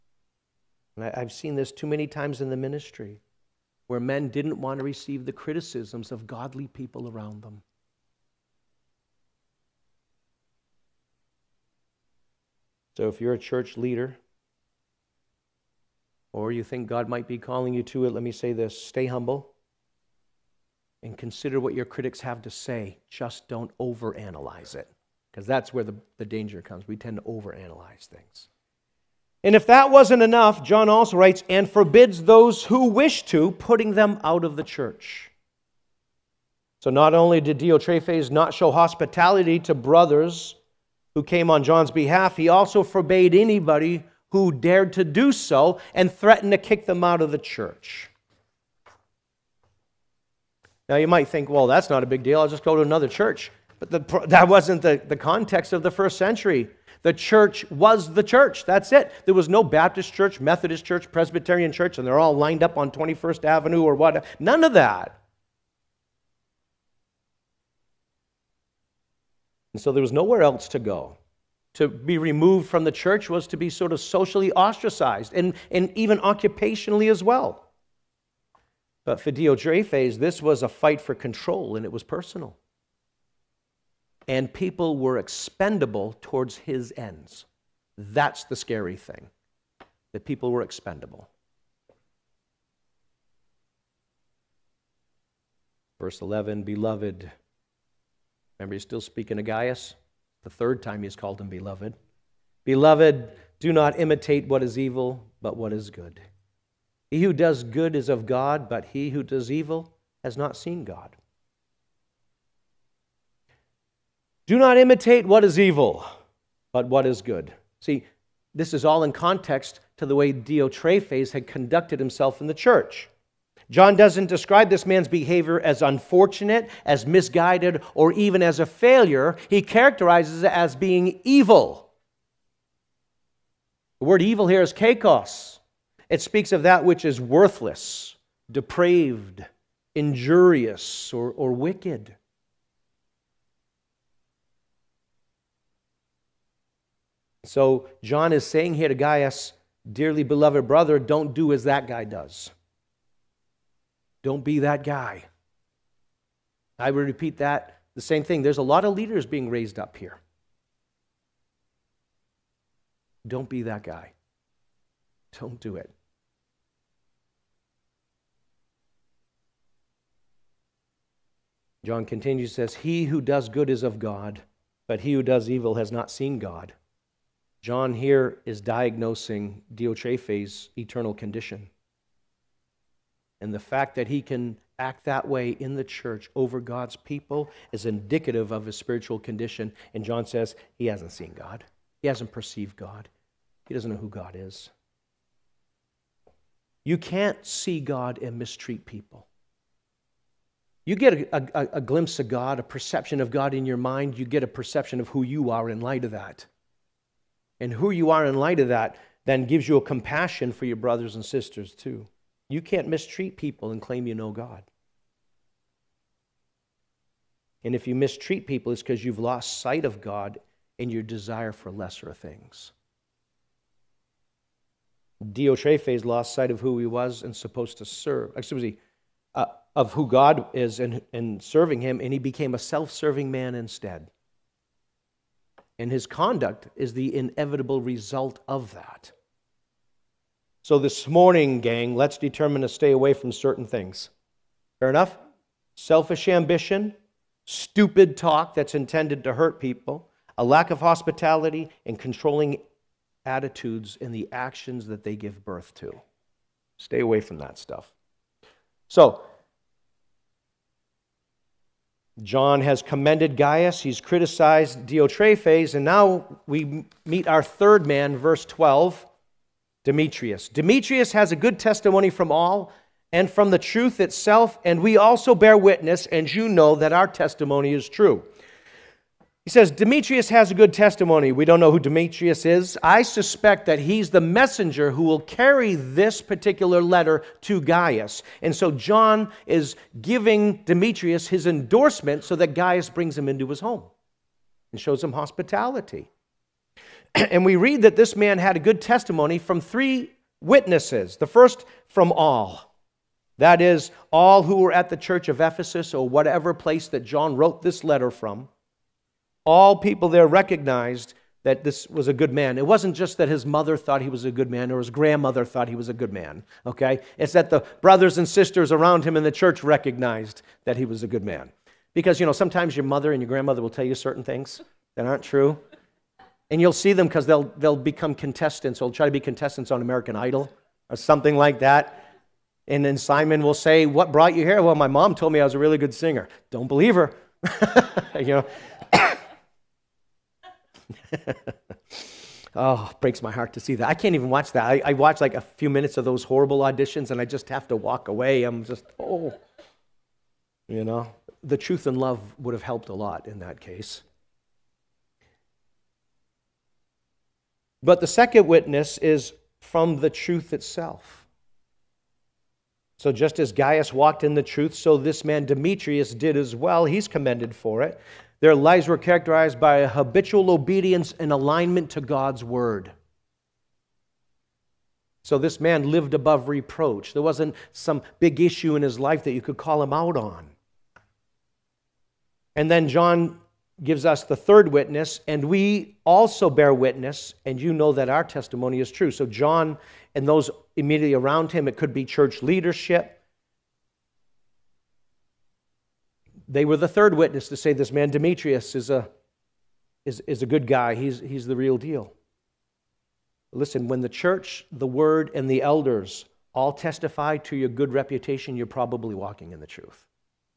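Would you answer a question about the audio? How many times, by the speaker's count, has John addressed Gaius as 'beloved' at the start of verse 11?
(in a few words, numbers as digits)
3.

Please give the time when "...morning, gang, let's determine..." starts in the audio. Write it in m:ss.
4:01.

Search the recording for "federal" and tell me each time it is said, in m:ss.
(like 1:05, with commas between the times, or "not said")
not said.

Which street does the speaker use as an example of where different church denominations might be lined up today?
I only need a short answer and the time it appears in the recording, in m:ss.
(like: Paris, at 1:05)
21st Avenue, at 1:02.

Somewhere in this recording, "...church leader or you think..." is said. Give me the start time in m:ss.
0:13.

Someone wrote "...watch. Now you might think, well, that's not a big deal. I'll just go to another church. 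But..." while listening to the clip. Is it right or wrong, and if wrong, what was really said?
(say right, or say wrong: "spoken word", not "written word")
wrong: "church", not "watch".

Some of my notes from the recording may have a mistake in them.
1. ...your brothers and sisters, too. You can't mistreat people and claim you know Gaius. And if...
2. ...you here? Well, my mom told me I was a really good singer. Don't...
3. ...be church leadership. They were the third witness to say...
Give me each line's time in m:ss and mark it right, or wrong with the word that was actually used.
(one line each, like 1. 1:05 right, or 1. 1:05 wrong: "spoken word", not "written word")
1. 3:30 wrong: "God", not "Gaius"
2. 5:34 right
3. 6:31 right.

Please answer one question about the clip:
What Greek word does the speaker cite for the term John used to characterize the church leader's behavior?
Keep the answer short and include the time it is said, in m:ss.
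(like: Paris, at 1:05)
kakos, at 2:14.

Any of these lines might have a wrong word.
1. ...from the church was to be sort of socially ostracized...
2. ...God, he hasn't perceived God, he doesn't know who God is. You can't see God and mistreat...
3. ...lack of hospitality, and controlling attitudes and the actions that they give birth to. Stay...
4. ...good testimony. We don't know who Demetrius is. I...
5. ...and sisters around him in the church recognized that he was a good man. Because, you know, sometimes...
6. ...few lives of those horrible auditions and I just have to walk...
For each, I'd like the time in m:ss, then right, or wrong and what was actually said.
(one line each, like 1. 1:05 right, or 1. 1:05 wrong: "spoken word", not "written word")
1. 1:12 right
2. 3:11 right
3. 4:10 right
4. 4:40 right
5. 5:18 right
6. 5:45 wrong: "minutes", not "lives".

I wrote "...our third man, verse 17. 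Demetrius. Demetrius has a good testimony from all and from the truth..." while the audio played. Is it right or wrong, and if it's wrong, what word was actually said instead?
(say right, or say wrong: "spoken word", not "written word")
wrong: "12", not "17".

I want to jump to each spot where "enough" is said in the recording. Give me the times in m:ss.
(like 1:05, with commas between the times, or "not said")
0:30, 4:04.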